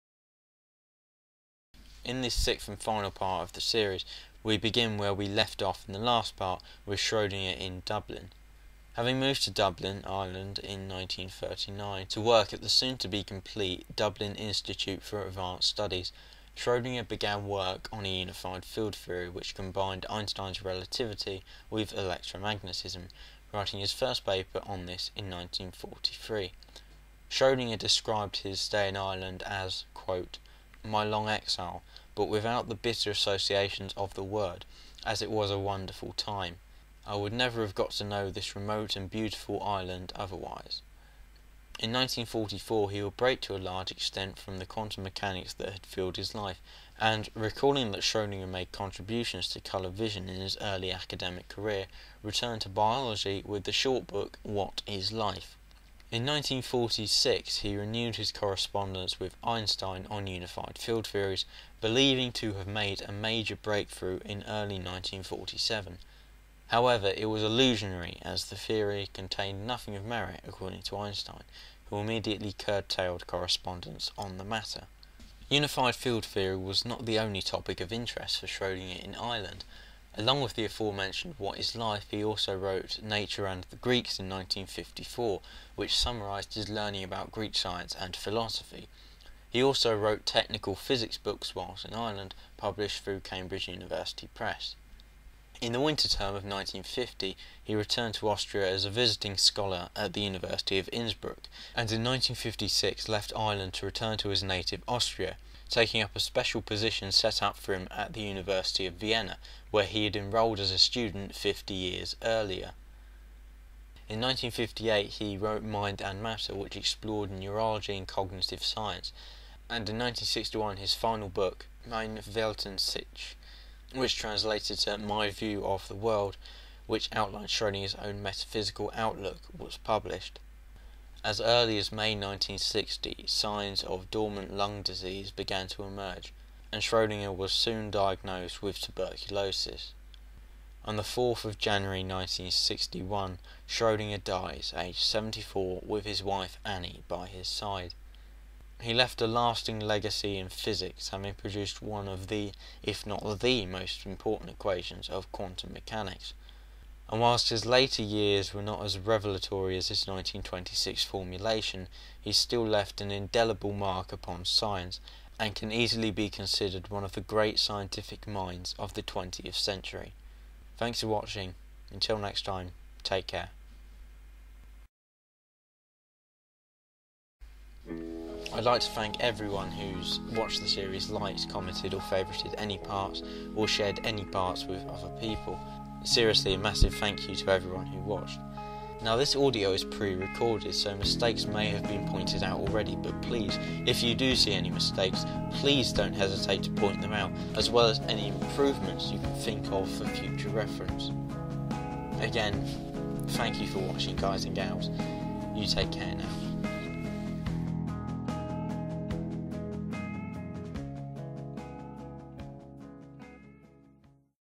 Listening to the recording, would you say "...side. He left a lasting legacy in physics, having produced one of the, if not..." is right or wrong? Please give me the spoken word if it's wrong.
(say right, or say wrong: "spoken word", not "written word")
right.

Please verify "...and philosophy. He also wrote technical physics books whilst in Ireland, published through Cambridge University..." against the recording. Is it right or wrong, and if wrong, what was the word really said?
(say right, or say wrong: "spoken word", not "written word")
right.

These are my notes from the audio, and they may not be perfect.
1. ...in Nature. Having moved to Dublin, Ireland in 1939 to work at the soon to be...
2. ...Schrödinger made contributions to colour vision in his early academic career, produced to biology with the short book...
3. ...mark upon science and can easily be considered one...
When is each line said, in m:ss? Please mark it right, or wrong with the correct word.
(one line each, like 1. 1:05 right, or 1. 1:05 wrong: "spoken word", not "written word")
1. 0:07 wrong: "Dublin", not "Nature"
2. 0:48 wrong: "returned", not "produced"
3. 2:43 right.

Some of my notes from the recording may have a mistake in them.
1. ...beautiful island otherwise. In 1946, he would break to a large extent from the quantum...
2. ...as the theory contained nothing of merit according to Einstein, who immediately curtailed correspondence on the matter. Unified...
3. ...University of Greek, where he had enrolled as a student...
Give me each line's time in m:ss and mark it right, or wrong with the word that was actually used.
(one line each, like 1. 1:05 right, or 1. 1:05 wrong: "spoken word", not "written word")
1. 0:39 wrong: "1944", not "1946"
2. 1:08 right
3. 1:48 wrong: "Vienna", not "Greek".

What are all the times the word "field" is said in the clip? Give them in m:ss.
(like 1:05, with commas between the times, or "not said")
0:18, 1:00, 1:15.